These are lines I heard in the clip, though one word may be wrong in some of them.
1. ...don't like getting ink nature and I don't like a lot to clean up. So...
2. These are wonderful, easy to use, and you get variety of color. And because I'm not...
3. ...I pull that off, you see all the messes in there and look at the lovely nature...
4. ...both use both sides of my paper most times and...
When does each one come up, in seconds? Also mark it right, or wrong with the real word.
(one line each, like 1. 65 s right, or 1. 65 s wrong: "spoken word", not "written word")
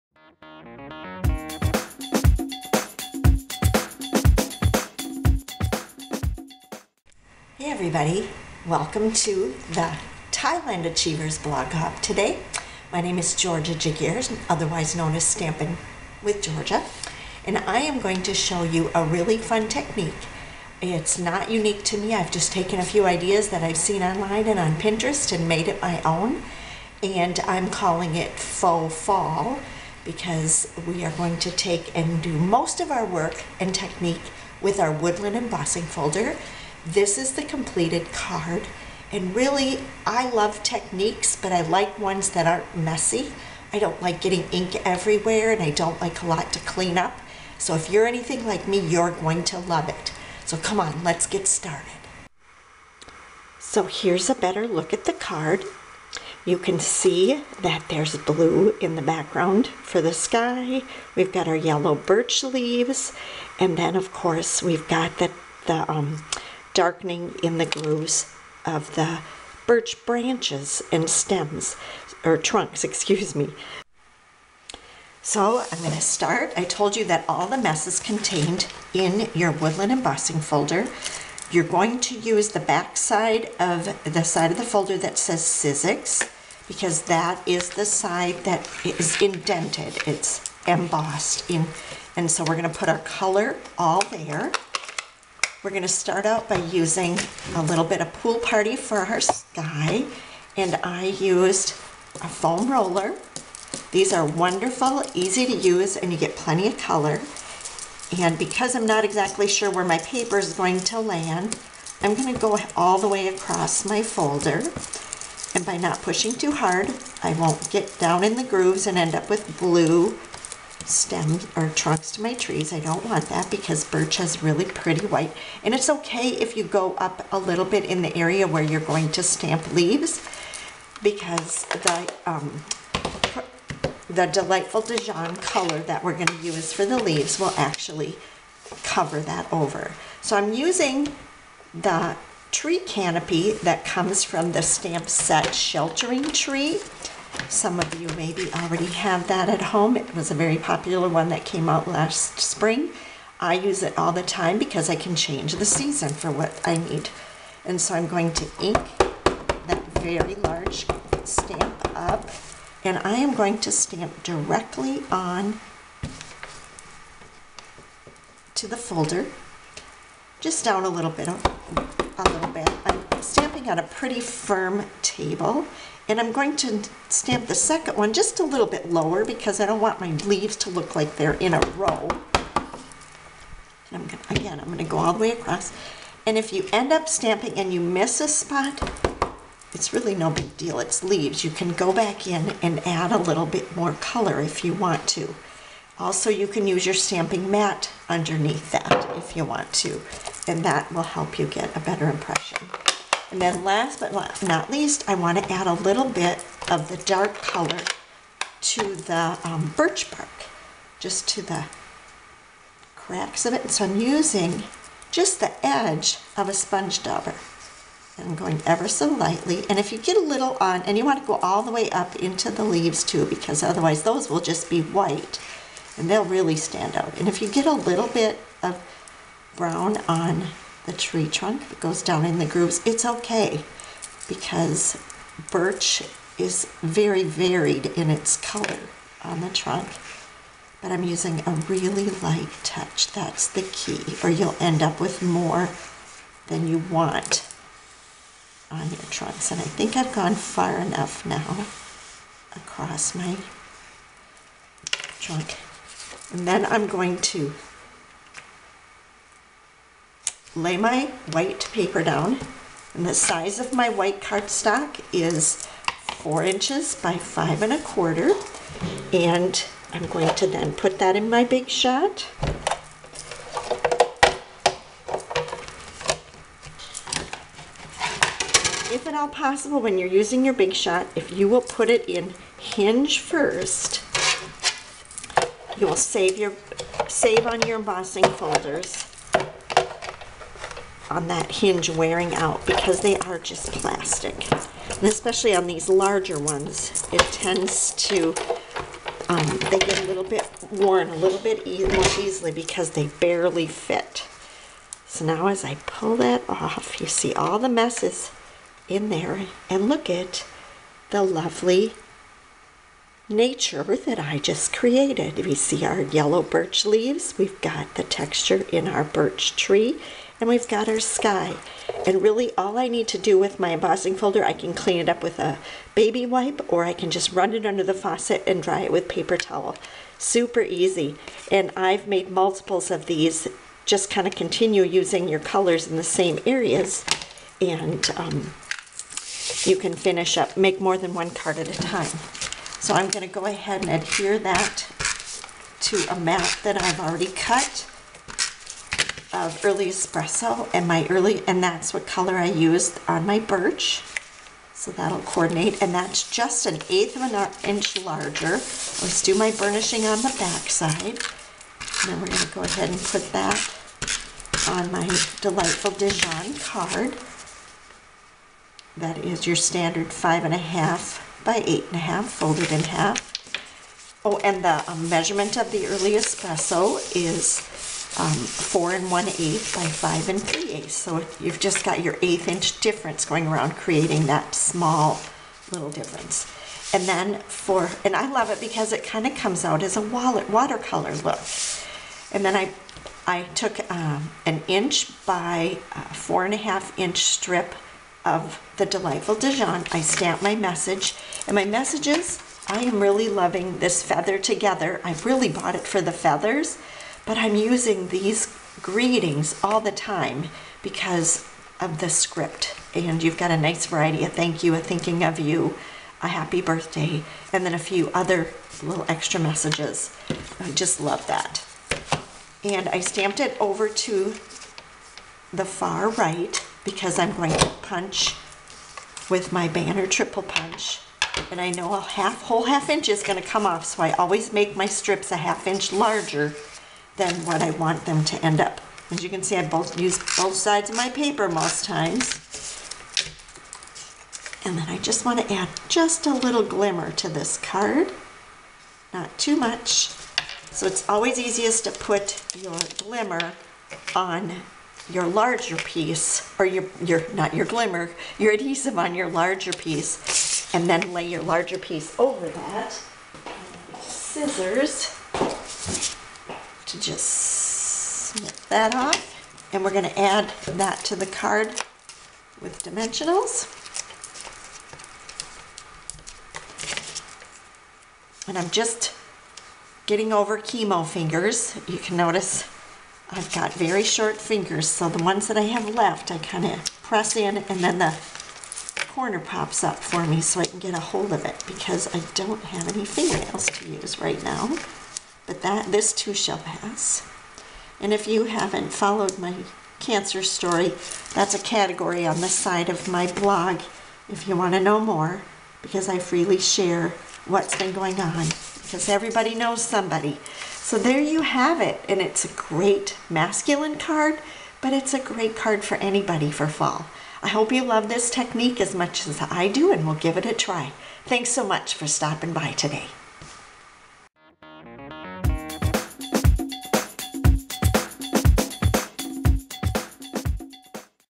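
1. 43 s wrong: "everywhere", not "nature"
2. 103 s wrong: "plenty", not "variety"
3. 305 s right
4. 439 s right.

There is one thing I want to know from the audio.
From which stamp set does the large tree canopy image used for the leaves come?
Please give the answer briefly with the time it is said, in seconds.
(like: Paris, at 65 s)
Sheltering Tree, at 145 s.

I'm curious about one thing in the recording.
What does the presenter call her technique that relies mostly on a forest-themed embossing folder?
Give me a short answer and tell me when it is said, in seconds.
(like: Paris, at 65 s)
faux fall, at 28 s.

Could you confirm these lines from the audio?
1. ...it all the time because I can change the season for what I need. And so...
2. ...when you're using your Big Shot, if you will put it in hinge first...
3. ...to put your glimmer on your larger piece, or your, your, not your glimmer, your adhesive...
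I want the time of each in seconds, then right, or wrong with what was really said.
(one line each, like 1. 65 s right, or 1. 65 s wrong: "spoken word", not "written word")
1. 153 s right
2. 279 s right
3. 451 s right.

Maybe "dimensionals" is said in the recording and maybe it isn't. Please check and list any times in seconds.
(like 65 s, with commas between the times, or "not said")
472 s.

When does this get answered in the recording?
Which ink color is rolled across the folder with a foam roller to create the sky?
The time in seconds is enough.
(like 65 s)
98 s.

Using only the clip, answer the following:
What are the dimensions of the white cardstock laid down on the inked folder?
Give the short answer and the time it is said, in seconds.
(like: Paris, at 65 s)
4 by 5 1/4 inches, at 266 s.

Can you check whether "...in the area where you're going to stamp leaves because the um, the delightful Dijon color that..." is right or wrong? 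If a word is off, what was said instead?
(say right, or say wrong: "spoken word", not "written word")
right.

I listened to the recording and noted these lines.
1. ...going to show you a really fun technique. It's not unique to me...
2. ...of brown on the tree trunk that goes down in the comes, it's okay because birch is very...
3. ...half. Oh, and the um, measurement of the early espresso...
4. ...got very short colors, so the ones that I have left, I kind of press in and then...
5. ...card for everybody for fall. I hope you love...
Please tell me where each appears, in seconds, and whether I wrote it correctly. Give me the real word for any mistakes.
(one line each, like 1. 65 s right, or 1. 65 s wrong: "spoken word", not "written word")
1. 17 s right
2. 228 s wrong: "grooves", not "comes"
3. 372 s right
4. 483 s wrong: "fingers", not "colors"
5. 515 s wrong: "anybody", not "everybody".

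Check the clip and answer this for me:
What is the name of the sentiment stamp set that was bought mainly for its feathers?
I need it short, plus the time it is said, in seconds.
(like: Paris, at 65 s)
Feather Together, at 404 s.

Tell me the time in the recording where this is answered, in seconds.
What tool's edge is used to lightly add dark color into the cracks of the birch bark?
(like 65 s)
216 s.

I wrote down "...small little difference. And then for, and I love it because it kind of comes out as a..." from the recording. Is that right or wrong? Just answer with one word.
right.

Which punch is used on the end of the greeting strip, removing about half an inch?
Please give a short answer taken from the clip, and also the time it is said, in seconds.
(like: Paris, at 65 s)
banner triple punch, at 429 s.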